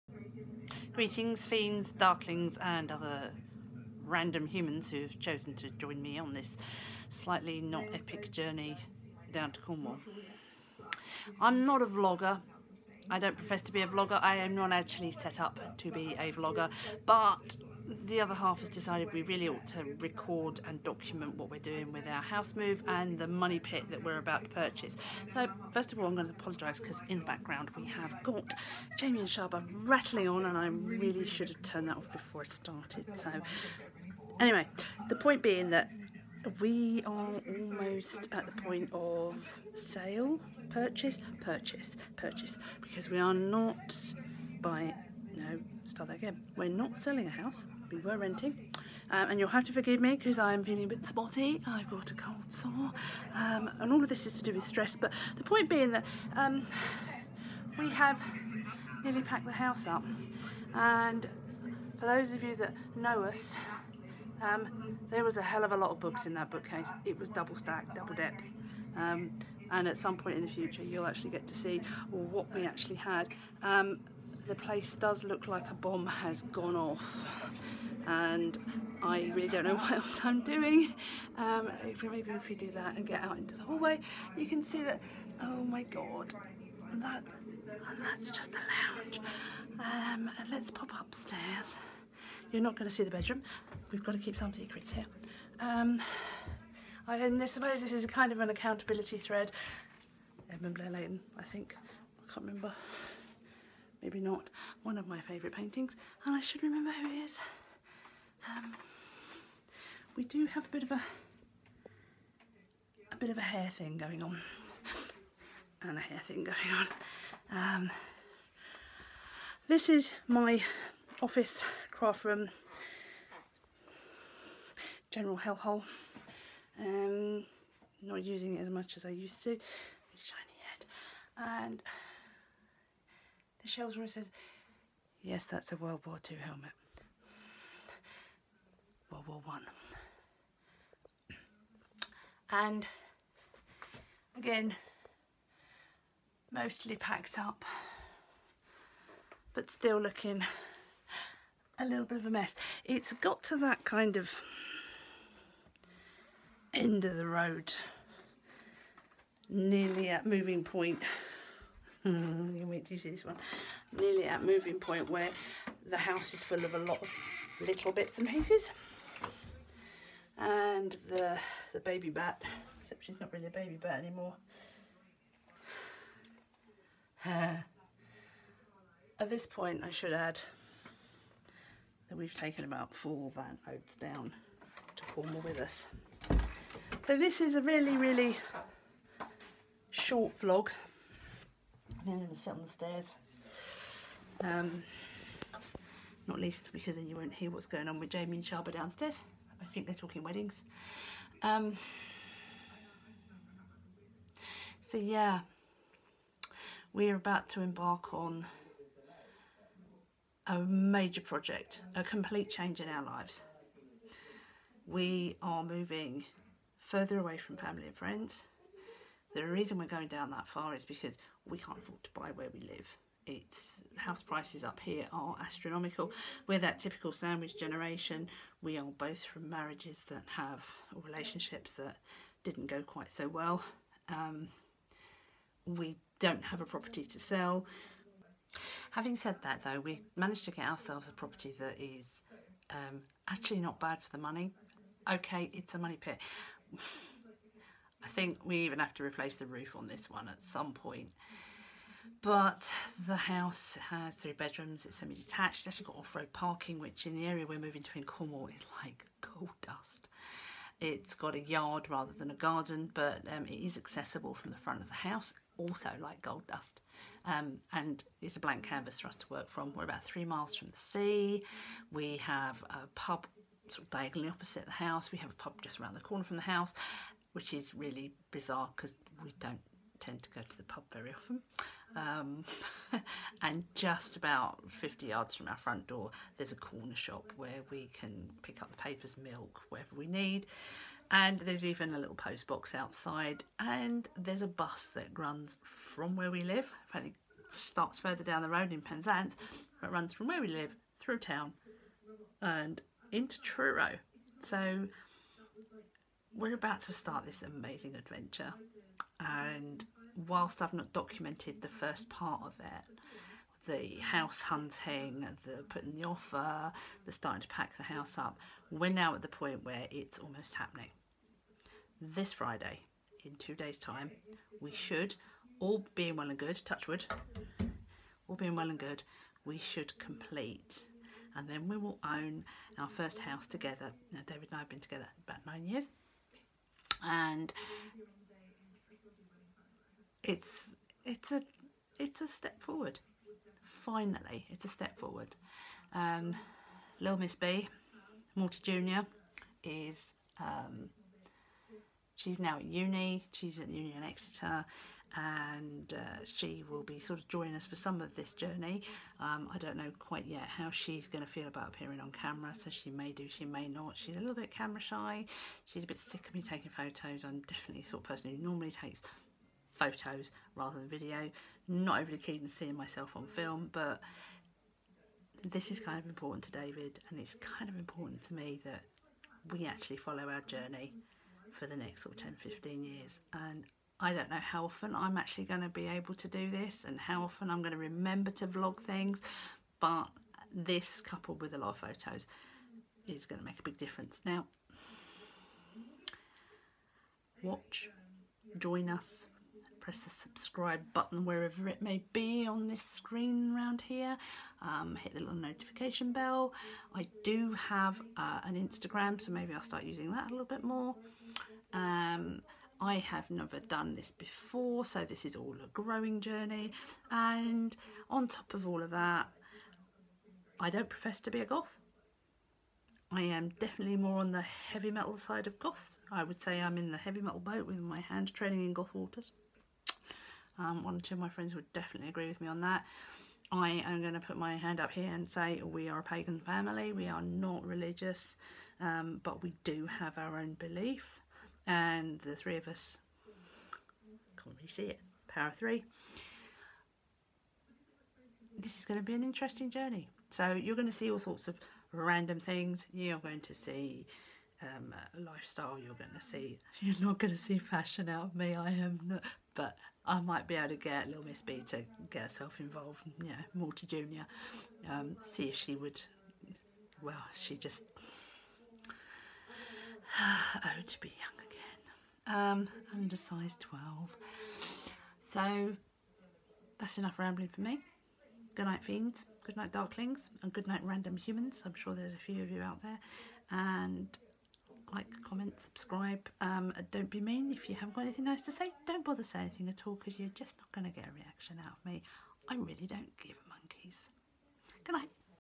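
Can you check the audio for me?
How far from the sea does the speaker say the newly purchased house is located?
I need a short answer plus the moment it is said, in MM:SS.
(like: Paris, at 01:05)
3 miles, at 04:30.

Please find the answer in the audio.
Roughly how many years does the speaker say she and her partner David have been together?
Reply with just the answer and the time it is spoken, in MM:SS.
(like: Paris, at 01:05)
9, at 05:35.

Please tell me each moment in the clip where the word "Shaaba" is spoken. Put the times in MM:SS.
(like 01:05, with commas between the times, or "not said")
00:29, 03:18.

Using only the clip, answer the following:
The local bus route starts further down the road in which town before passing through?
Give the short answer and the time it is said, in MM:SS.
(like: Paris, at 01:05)
Penzance, at 04:58.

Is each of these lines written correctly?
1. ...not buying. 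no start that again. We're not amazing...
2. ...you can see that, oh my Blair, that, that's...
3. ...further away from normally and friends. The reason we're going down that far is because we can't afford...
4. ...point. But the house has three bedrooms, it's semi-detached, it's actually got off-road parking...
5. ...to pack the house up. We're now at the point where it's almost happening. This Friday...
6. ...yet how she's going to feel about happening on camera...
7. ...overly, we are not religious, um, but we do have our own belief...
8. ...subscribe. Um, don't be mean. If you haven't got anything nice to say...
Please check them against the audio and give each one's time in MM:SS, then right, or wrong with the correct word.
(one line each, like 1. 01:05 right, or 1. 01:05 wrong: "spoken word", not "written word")
1. 00:43 wrong: "selling", not "amazing"
2. 01:24 wrong: "God", not "Blair"
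3. 03:36 wrong: "family", not "normally"
4. 04:10 right
5. 05:17 right
6. 06:00 wrong: "appearing", not "happening"
7. 07:16 wrong: "family", not "overly"
8. 08:05 right.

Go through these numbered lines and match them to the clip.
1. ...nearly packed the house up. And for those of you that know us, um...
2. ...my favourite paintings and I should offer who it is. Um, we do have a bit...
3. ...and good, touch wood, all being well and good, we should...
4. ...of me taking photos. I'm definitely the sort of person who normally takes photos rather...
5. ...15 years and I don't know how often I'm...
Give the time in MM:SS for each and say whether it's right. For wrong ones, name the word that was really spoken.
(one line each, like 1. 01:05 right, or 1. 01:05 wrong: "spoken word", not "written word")
1. 00:59 right
2. 01:45 wrong: "remember", not "offer"
3. 05:26 right
4. 06:06 right
5. 06:22 right.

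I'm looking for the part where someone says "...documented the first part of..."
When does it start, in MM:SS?
05:10.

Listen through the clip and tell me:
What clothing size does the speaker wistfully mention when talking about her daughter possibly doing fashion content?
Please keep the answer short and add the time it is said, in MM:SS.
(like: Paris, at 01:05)
12, at 07:53.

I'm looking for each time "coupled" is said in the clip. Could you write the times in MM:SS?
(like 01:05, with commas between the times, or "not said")
06:31.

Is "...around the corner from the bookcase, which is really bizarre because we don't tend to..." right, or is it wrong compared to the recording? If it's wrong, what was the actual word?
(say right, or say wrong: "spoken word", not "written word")
wrong: "house", not "bookcase".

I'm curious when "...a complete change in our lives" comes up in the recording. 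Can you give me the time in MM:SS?
03:31.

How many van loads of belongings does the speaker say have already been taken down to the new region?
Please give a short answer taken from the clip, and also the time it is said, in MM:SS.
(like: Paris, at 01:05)
4, at 03:02.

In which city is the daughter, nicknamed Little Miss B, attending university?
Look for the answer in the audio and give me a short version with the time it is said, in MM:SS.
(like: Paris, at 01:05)
Exeter, at 05:54.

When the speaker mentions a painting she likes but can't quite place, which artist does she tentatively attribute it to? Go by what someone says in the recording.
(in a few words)
Edmund Blair Leighton.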